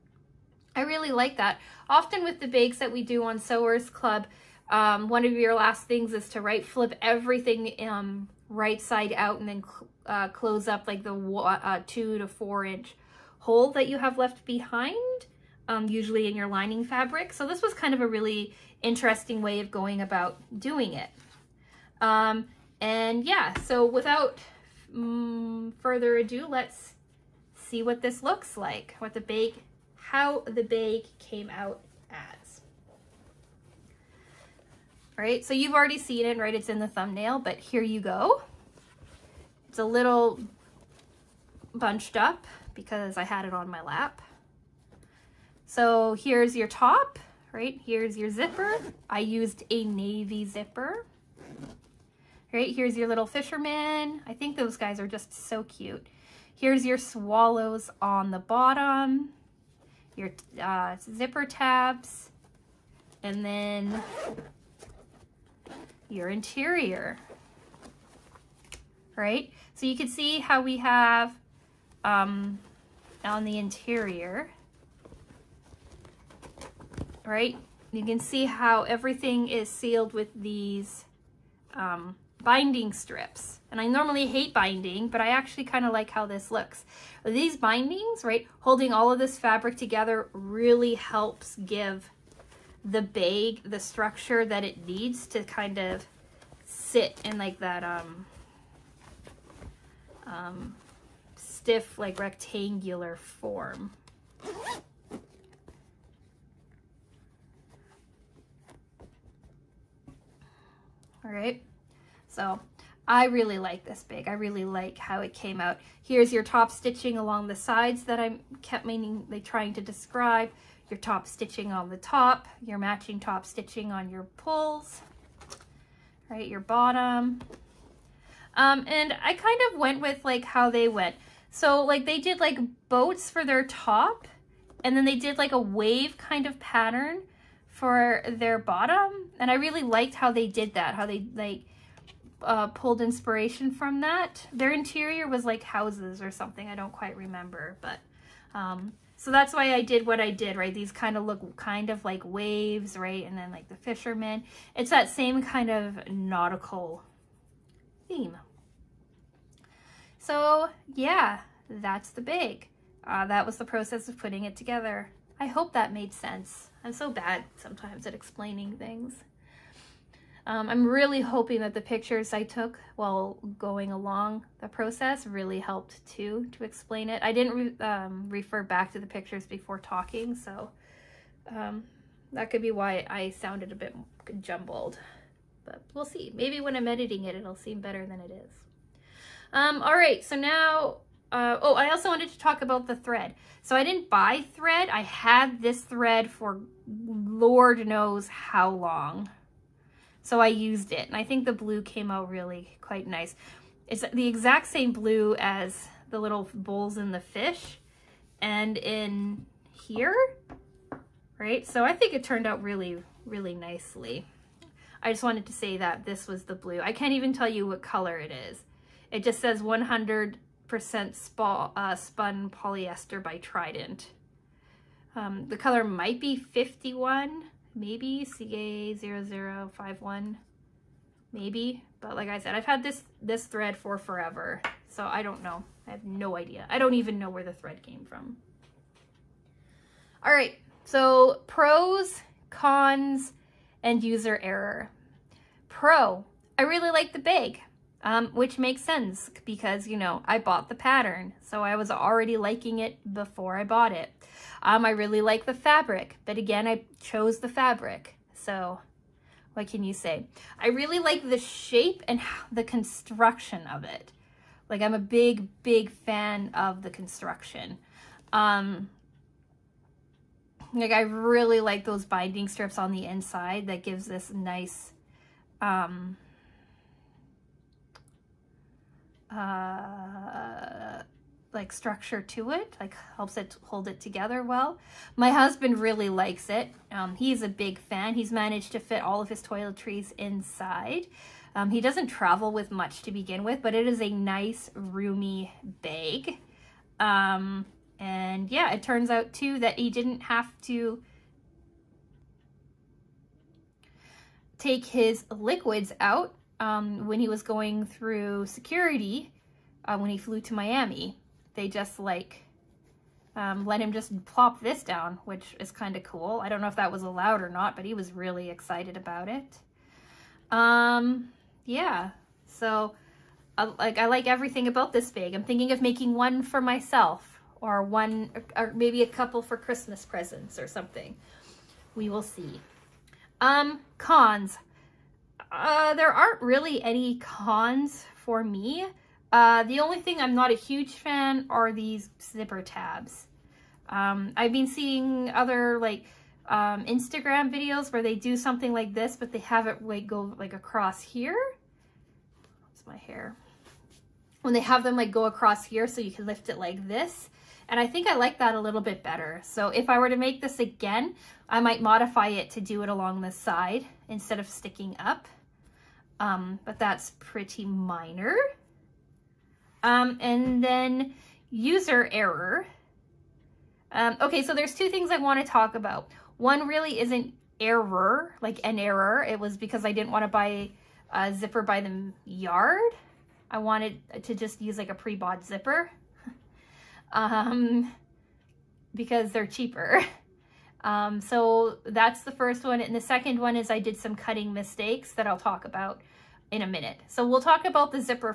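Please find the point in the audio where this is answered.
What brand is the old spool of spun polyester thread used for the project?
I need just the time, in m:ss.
3:43.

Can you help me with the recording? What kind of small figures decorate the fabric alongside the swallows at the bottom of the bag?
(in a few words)
Fishermen.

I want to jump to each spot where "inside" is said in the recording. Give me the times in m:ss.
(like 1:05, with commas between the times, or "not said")
4:33, 4:50.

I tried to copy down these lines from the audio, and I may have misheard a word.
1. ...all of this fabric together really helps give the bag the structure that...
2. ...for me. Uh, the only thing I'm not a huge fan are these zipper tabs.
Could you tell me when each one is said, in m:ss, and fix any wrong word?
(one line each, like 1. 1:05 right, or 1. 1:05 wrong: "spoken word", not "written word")
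1. 1:28 right
2. 5:38 right.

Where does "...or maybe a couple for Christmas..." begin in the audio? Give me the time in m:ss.
5:28.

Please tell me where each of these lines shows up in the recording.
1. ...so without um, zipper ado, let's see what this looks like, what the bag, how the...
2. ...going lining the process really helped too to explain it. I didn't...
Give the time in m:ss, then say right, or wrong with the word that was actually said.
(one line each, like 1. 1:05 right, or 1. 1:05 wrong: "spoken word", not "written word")
1. 0:23 wrong: "further", not "zipper"
2. 2:53 wrong: "along", not "lining".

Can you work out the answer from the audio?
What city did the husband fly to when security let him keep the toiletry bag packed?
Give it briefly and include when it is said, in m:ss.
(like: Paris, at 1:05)
Miami, at 5:10.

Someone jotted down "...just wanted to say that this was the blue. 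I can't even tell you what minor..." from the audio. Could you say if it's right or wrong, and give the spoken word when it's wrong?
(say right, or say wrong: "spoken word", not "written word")
wrong: "color", not "minor".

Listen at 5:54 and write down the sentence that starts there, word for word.
When they have them like go across here so you can lift it like this.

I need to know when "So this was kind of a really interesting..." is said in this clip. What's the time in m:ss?
0:17.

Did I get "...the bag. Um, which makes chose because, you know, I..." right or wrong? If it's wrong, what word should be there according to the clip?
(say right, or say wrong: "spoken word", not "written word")
wrong: "sense", not "chose".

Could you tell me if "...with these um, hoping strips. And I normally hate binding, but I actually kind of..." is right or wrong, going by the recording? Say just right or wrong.
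wrong.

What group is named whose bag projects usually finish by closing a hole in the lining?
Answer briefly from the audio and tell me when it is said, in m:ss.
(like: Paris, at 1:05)
Sewers Club, at 0:03.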